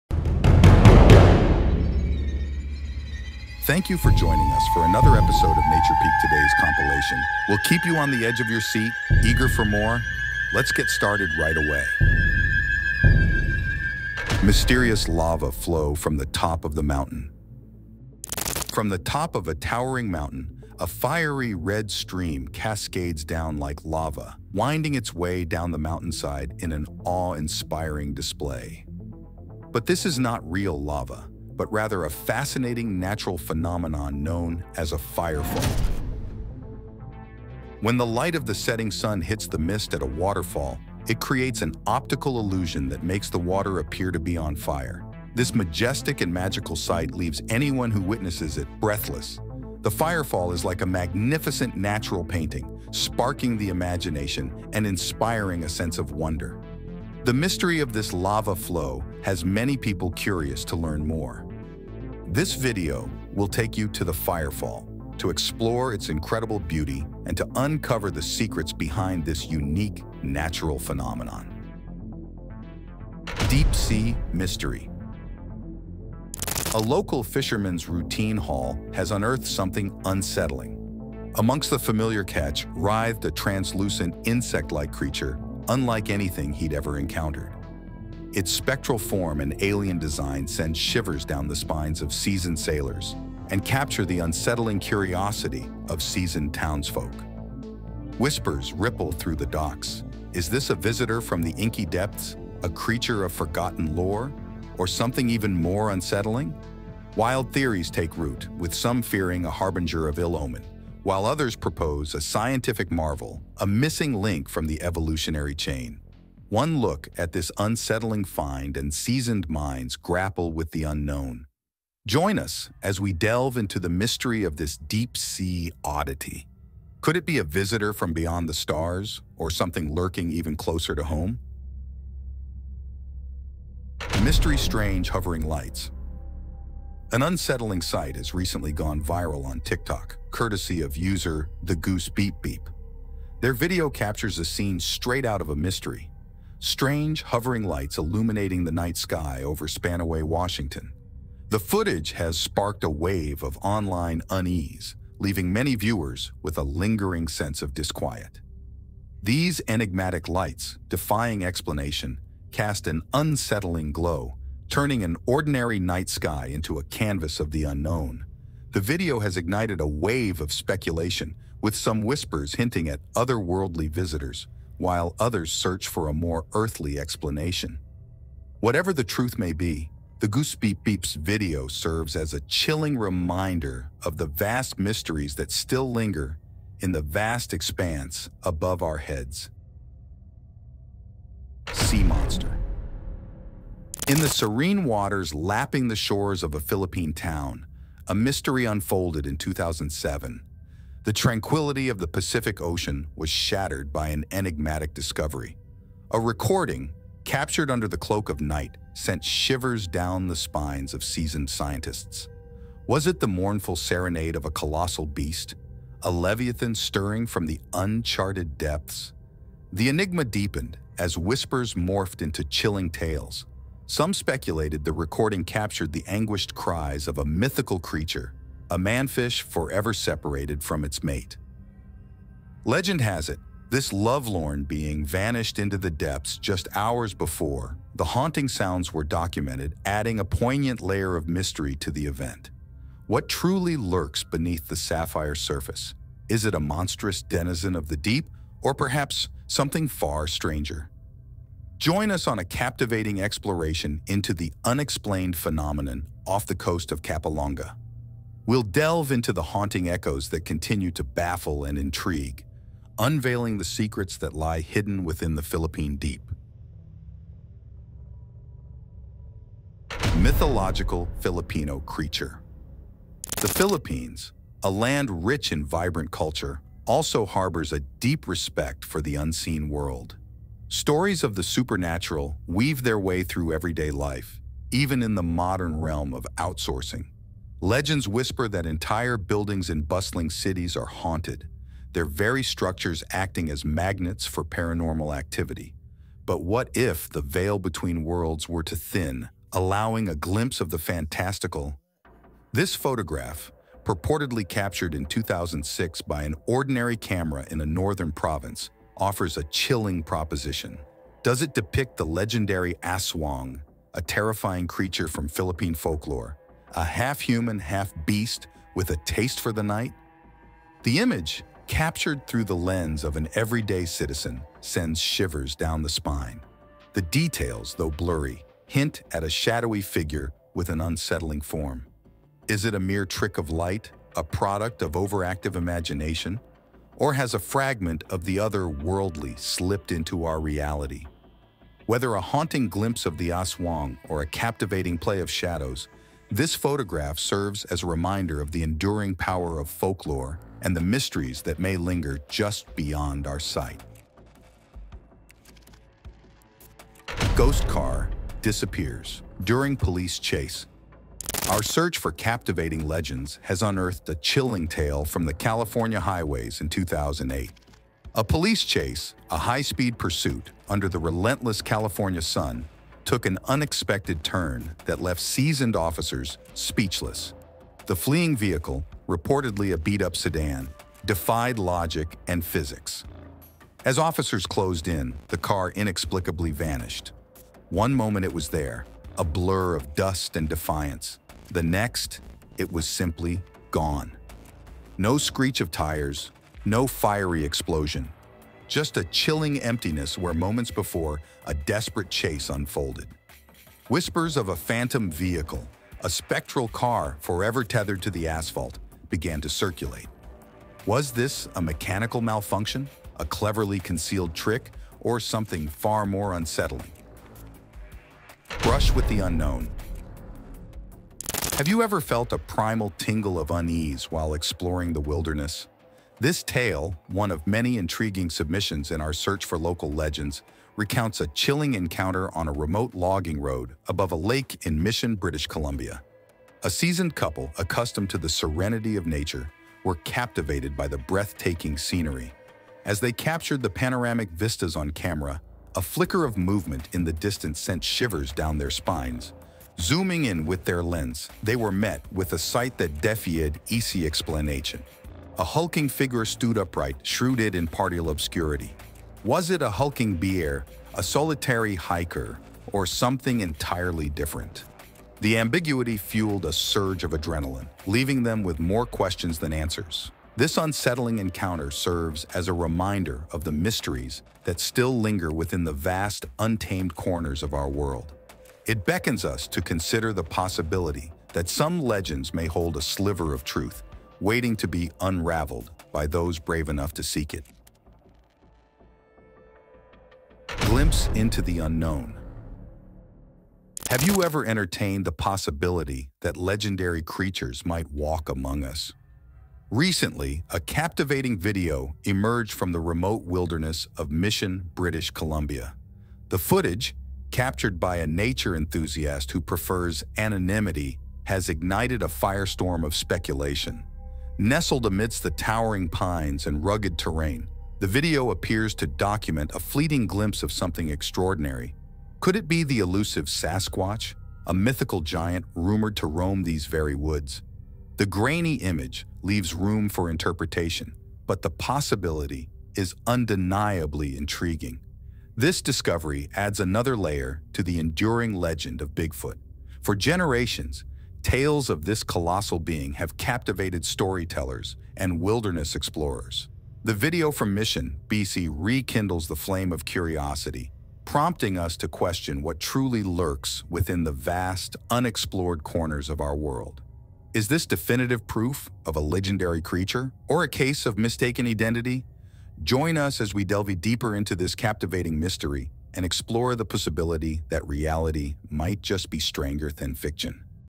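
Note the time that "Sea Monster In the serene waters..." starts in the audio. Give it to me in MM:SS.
03:11.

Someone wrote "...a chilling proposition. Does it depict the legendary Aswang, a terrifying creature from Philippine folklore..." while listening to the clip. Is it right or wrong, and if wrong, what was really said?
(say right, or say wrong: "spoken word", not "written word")
right.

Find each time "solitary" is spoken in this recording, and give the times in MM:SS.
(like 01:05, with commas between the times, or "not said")
07:41.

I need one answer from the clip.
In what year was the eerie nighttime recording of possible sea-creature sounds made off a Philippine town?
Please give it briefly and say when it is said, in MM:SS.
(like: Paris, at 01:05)
2007, at 03:19.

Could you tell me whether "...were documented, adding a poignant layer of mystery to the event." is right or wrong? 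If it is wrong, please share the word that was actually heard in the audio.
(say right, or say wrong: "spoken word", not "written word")
right.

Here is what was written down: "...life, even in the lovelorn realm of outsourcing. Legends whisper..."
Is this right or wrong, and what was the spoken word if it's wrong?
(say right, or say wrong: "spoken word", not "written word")
wrong: "modern", not "lovelorn".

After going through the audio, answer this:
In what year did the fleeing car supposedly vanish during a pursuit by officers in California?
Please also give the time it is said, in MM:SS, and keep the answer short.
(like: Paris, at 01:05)
2008, at 06:06.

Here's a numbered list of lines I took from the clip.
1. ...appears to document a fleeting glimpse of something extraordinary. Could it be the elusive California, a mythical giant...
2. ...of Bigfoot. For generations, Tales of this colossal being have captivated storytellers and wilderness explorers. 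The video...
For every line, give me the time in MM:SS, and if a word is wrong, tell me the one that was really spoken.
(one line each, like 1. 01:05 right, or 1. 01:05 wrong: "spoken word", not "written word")
1. 08:38 wrong: "Sasquatch", not "California"
2. 08:58 right.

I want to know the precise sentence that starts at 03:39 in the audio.
The enigma deepened as whispers morphed into chilling tales.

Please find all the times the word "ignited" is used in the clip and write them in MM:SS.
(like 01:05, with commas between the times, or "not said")
02:49, 08:31.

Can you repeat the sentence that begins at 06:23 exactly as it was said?
As officers closed in, the car inexplicably vanished.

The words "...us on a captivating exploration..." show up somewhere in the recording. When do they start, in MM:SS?
04:12.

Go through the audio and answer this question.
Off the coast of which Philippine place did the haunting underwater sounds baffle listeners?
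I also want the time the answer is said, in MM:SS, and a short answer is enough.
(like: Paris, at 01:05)
Capalonga, at 04:17.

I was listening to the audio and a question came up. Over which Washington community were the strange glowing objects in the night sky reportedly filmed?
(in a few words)
Spanaway.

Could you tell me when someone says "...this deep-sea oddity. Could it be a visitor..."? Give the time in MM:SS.
02:04.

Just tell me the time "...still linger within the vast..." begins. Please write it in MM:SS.
07:54.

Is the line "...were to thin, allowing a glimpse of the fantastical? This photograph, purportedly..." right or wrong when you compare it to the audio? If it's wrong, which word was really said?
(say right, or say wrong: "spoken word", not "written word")
right.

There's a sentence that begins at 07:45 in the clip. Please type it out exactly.
The ambiguity fueled a surge of adrenaline, leaving them with more questions than answers.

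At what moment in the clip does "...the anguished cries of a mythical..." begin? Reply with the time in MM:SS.
03:45.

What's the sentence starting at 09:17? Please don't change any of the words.
Is this definitive proof of a legendary creature or a case of mistaken identity?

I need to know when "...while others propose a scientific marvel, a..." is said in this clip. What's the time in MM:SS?
01:51.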